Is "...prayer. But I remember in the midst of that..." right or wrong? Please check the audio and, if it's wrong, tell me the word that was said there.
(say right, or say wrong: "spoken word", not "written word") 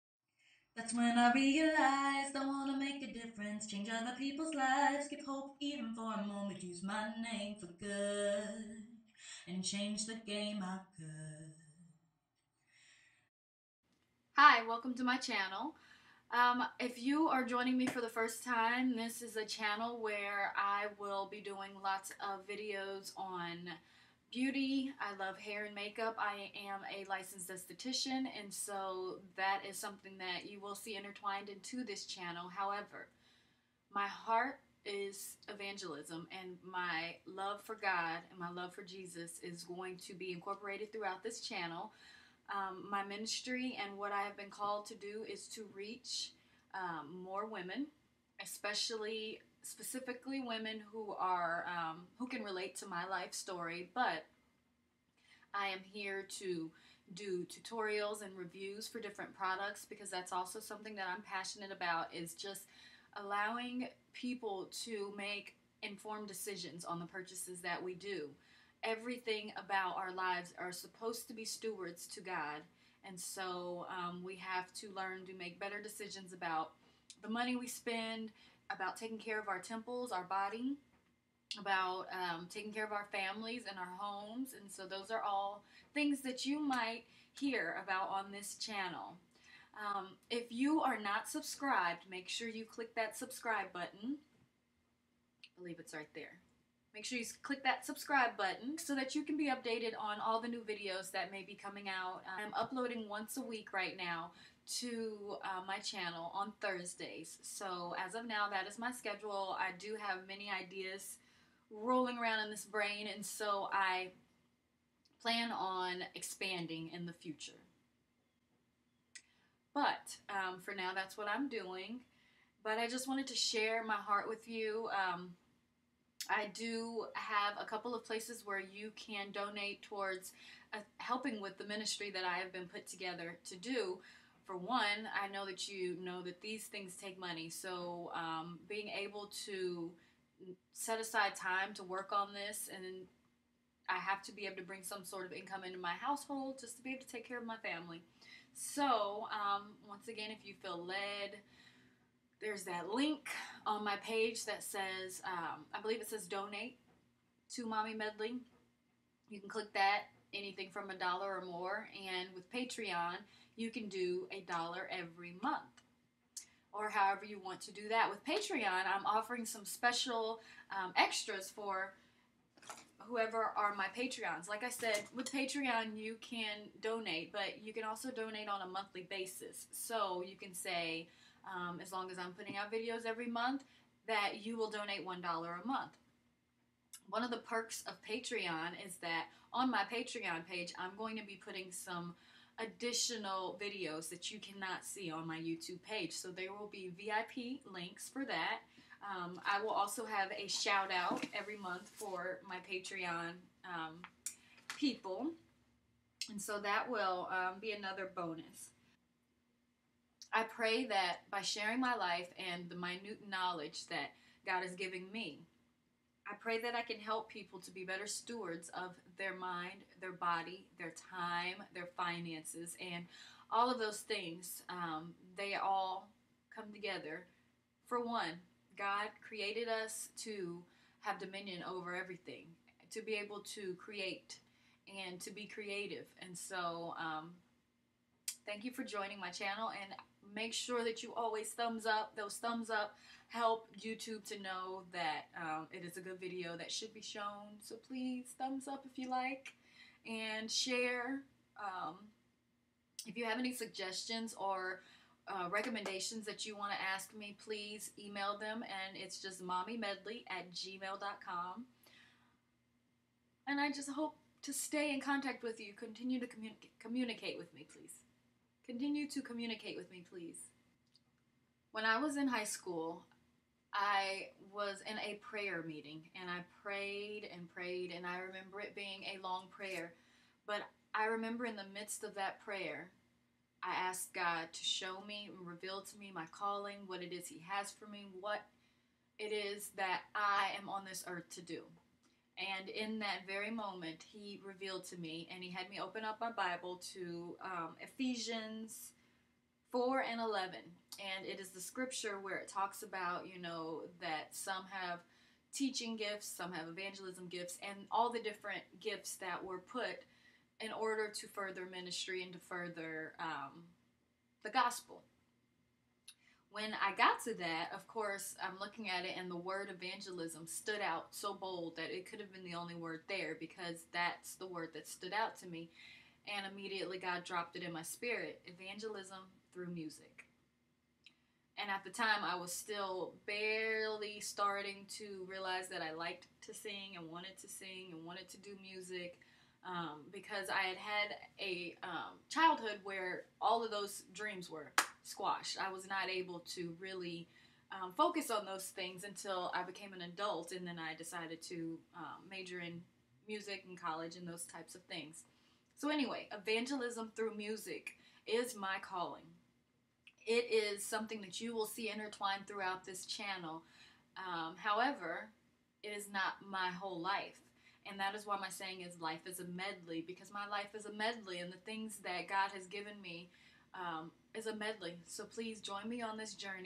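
right.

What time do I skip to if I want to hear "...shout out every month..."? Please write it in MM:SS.
03:20.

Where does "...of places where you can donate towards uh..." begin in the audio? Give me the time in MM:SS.
02:07.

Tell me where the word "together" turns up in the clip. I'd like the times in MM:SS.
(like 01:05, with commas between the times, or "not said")
02:12, 03:46.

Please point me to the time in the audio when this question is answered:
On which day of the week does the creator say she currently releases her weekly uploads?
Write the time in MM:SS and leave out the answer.
01:46.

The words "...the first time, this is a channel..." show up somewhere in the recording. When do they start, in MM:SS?
00:17.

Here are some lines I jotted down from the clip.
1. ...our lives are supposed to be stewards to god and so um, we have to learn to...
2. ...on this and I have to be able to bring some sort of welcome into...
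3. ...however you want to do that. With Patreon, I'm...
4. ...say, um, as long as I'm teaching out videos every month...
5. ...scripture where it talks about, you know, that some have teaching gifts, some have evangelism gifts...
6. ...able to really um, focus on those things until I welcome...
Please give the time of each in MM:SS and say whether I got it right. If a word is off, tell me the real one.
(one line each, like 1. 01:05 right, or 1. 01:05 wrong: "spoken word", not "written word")
1. 01:09 right
2. 02:22 wrong: "income", not "welcome"
3. 02:46 right
4. 03:00 wrong: "putting", not "teaching"
5. 05:01 right
6. 05:46 wrong: "became", not "welcome".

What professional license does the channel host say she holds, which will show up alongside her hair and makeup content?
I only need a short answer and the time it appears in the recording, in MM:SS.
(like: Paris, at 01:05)
esthetician, at 00:27.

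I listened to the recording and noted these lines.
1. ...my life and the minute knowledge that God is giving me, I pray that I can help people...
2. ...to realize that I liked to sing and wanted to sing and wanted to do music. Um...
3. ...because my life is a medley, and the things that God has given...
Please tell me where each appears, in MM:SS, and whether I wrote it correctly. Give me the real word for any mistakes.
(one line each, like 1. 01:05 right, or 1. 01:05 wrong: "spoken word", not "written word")
1. 03:31 right
2. 05:34 right
3. 06:10 right.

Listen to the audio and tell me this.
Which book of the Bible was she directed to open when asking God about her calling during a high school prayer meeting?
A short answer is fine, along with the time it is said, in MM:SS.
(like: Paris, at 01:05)
Ephesians, at 04:57.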